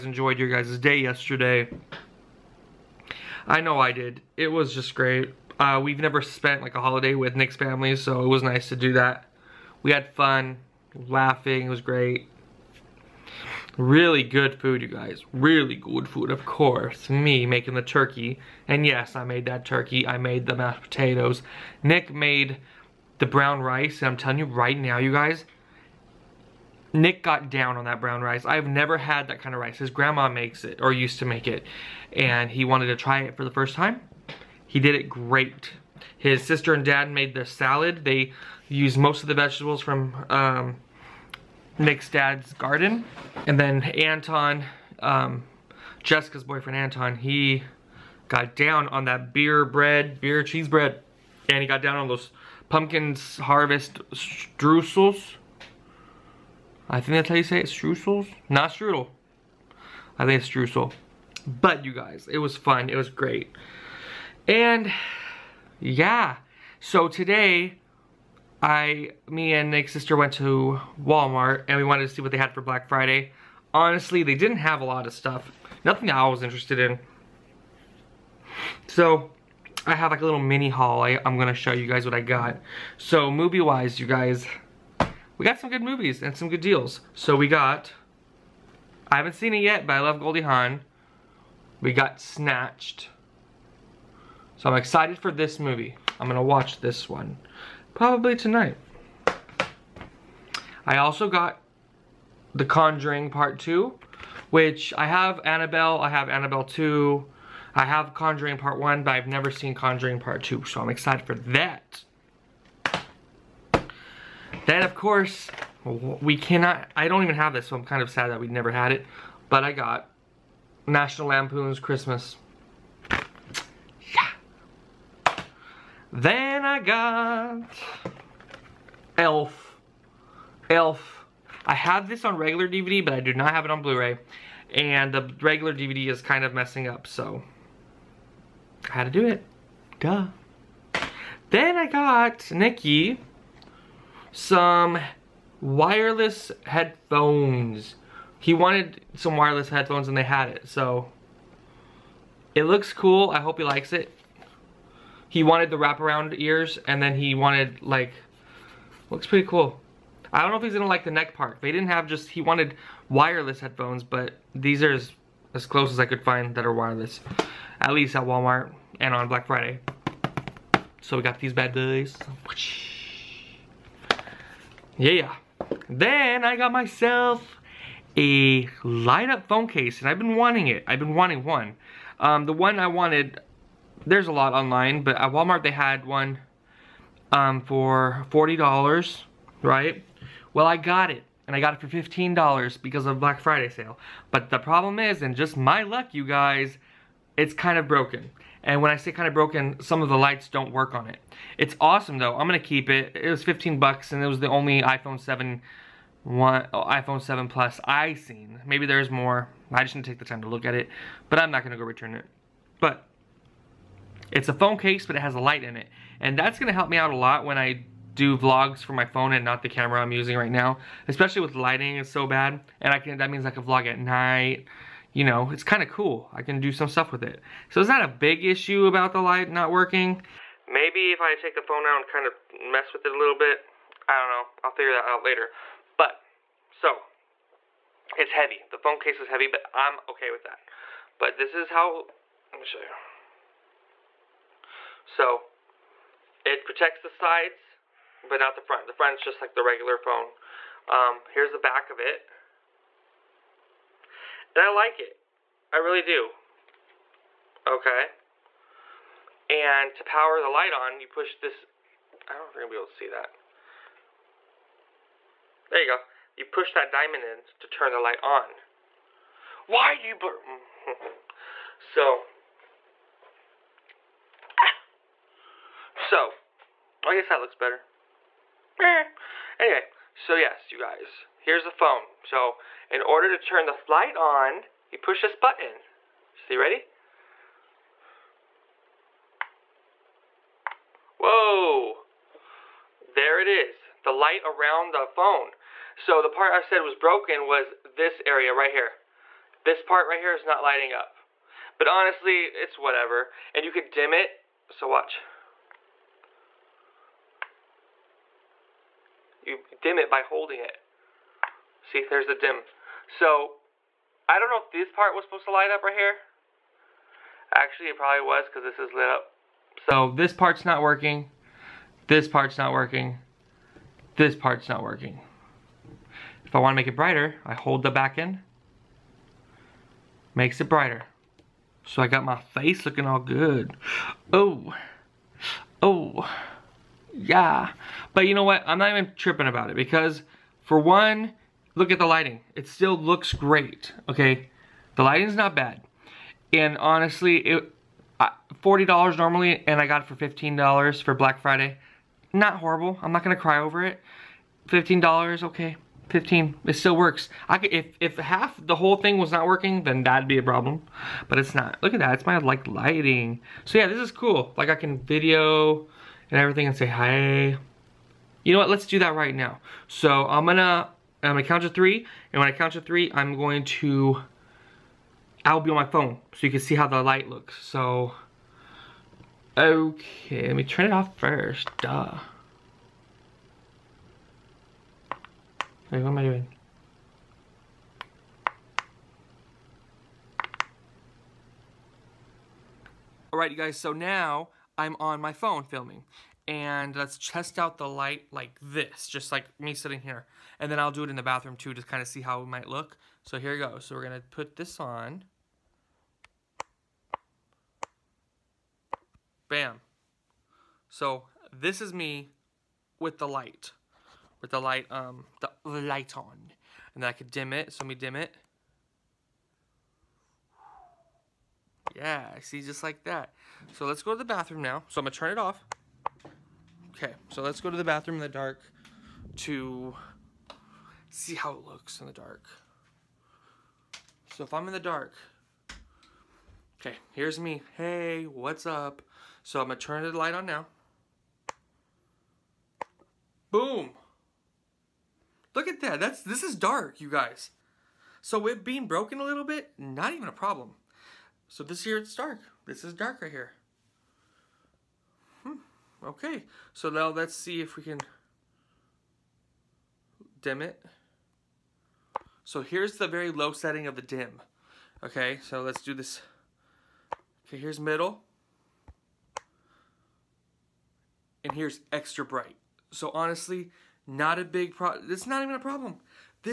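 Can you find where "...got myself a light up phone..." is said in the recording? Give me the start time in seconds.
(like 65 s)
176 s.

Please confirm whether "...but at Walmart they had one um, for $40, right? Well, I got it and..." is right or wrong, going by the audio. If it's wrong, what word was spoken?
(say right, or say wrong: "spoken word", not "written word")
right.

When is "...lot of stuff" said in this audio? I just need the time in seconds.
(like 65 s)
74 s.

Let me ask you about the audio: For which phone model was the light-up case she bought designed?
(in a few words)
iPhone 7 Plus.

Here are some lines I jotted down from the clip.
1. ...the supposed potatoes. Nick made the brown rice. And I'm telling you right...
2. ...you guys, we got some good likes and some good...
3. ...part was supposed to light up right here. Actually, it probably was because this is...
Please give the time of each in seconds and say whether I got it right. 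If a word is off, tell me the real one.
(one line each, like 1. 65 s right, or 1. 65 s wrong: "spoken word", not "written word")
1. 20 s wrong: "mashed", not "supposed"
2. 84 s wrong: "movies", not "likes"
3. 314 s right.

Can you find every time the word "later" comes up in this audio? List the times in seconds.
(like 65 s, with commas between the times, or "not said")
235 s.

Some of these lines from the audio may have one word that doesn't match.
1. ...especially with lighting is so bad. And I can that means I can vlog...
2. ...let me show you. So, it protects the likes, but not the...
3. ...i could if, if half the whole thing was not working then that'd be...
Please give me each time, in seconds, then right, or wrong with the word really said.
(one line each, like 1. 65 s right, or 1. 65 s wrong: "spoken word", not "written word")
1. 221 s right
2. 242 s wrong: "sides", not "likes"
3. 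357 s right.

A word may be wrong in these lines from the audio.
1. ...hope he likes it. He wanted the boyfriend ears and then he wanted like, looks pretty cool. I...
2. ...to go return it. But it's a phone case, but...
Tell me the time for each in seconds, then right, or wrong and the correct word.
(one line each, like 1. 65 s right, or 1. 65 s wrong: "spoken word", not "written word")
1. 153 s wrong: "wraparound", not "boyfriend"
2. 211 s right.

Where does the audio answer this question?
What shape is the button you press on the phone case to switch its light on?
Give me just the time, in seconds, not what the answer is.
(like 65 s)
266 s.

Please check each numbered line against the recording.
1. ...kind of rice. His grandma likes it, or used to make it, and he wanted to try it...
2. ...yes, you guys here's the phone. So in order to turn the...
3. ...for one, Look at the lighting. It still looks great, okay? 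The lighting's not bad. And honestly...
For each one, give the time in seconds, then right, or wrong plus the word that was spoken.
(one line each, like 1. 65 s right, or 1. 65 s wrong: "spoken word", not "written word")
1. 29 s wrong: "makes", not "likes"
2. 280 s right
3. 340 s right.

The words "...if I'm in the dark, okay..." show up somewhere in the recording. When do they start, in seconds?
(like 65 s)
434 s.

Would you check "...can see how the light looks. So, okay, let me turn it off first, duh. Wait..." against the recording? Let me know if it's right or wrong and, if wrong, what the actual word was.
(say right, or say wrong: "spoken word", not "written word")
right.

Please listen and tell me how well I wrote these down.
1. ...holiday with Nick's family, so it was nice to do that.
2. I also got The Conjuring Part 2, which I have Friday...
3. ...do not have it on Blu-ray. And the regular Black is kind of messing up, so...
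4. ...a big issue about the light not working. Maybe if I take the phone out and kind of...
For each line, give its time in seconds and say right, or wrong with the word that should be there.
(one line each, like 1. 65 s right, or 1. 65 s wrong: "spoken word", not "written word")
1. 6 s right
2. 100 s wrong: "Annabelle", not "Friday"
3. 133 s wrong: "DVD", not "Black"
4. 228 s right.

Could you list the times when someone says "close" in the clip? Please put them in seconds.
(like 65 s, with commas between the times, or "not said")
165 s.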